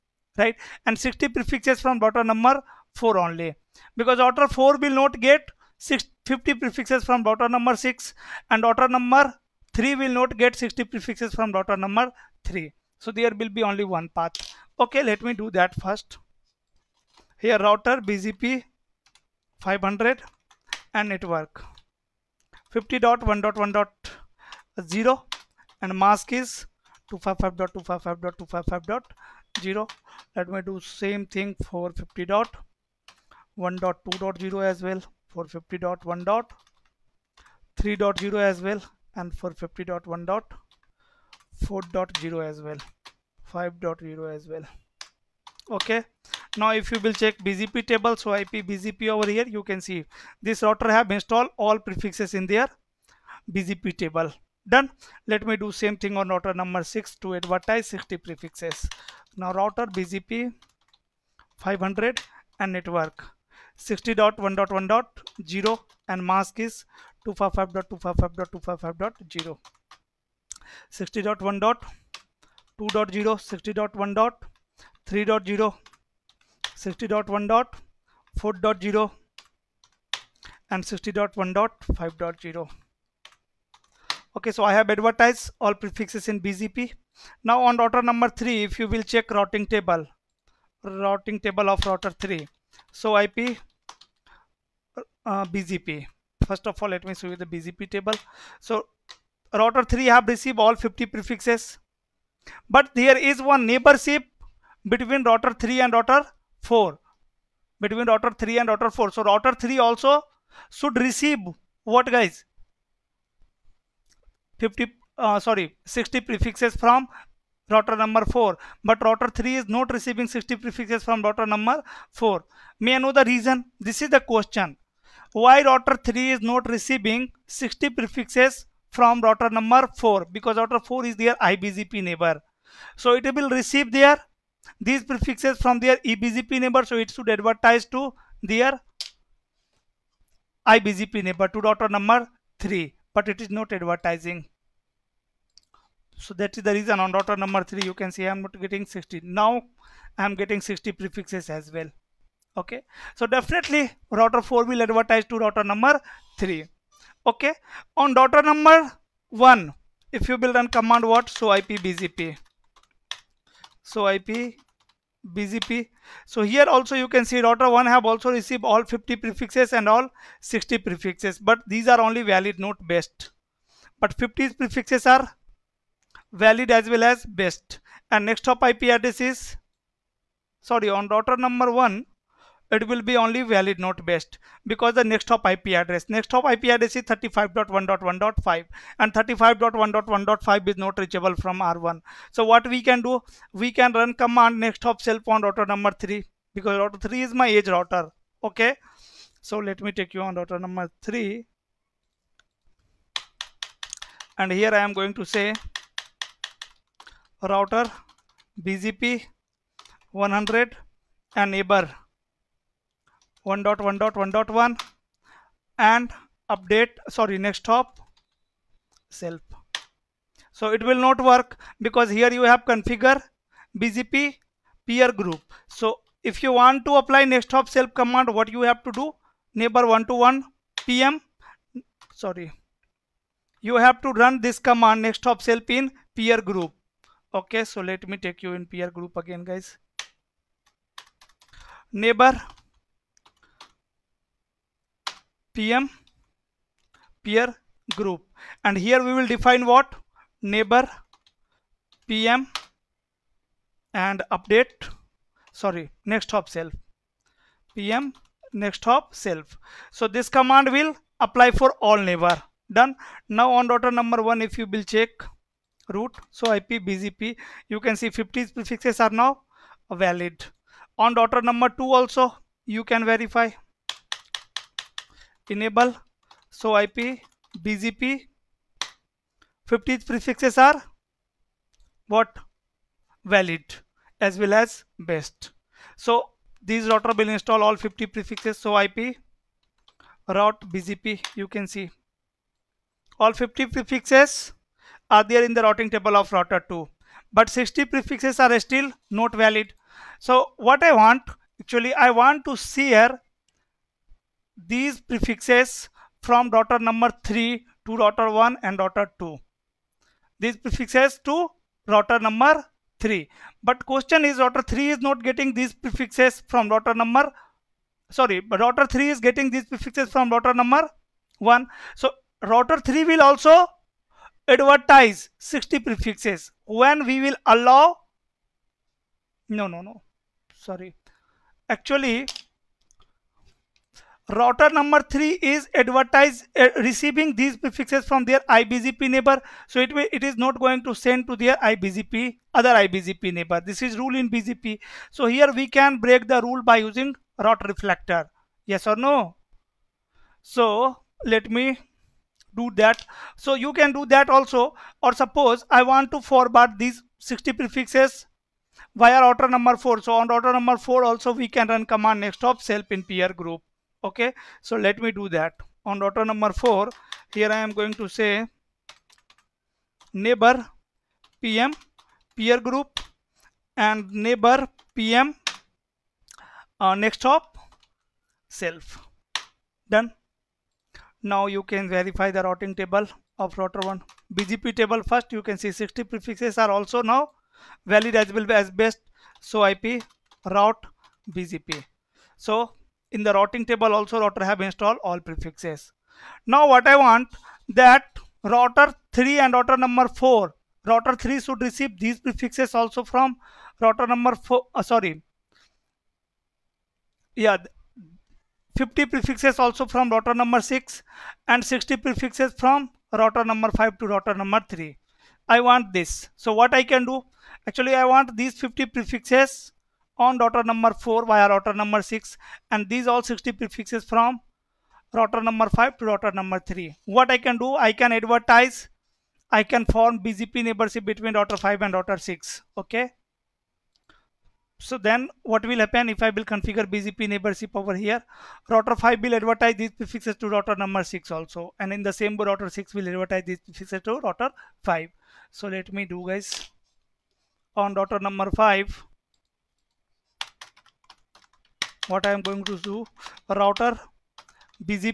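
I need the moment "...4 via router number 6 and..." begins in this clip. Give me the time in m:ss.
7:00.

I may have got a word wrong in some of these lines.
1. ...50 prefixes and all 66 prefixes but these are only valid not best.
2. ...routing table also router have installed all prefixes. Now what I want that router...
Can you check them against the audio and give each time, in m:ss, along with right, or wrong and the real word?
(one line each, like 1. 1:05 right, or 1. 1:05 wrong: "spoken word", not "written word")
1. 2:48 wrong: "60", not "66"
2. 6:33 right.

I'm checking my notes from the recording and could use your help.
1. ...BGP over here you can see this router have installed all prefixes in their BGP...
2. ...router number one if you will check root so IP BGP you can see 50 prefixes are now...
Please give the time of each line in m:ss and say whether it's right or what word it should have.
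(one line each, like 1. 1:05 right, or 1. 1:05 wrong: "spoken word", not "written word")
1. 0:48 right
2. 4:23 right.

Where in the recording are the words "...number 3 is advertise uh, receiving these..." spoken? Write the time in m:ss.
5:34.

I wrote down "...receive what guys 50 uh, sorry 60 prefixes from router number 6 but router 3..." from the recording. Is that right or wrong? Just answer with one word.
wrong.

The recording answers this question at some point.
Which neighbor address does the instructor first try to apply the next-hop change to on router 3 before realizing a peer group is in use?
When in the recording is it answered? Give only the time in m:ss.
3:31.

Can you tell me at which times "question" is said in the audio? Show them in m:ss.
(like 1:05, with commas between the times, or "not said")
2:04, 5:13.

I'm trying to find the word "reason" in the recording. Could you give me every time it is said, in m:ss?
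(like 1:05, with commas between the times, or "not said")
2:03, 2:26.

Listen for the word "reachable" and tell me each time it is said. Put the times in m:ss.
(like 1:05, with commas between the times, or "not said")
3:10.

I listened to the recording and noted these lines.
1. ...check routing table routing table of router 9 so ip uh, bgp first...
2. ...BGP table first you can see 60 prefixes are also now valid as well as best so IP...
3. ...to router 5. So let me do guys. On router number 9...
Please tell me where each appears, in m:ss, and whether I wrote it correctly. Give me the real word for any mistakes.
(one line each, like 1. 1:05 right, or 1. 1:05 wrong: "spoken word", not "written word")
1. 1:29 wrong: "3", not "9"
2. 6:24 right
3. 7:24 wrong: "5", not "9".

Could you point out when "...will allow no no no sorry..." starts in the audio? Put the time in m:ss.
5:27.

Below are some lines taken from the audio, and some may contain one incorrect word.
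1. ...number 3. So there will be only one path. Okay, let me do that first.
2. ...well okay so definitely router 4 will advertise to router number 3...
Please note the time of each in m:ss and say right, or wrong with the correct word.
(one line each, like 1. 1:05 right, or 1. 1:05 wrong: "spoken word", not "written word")
1. 0:11 right
2. 2:31 right.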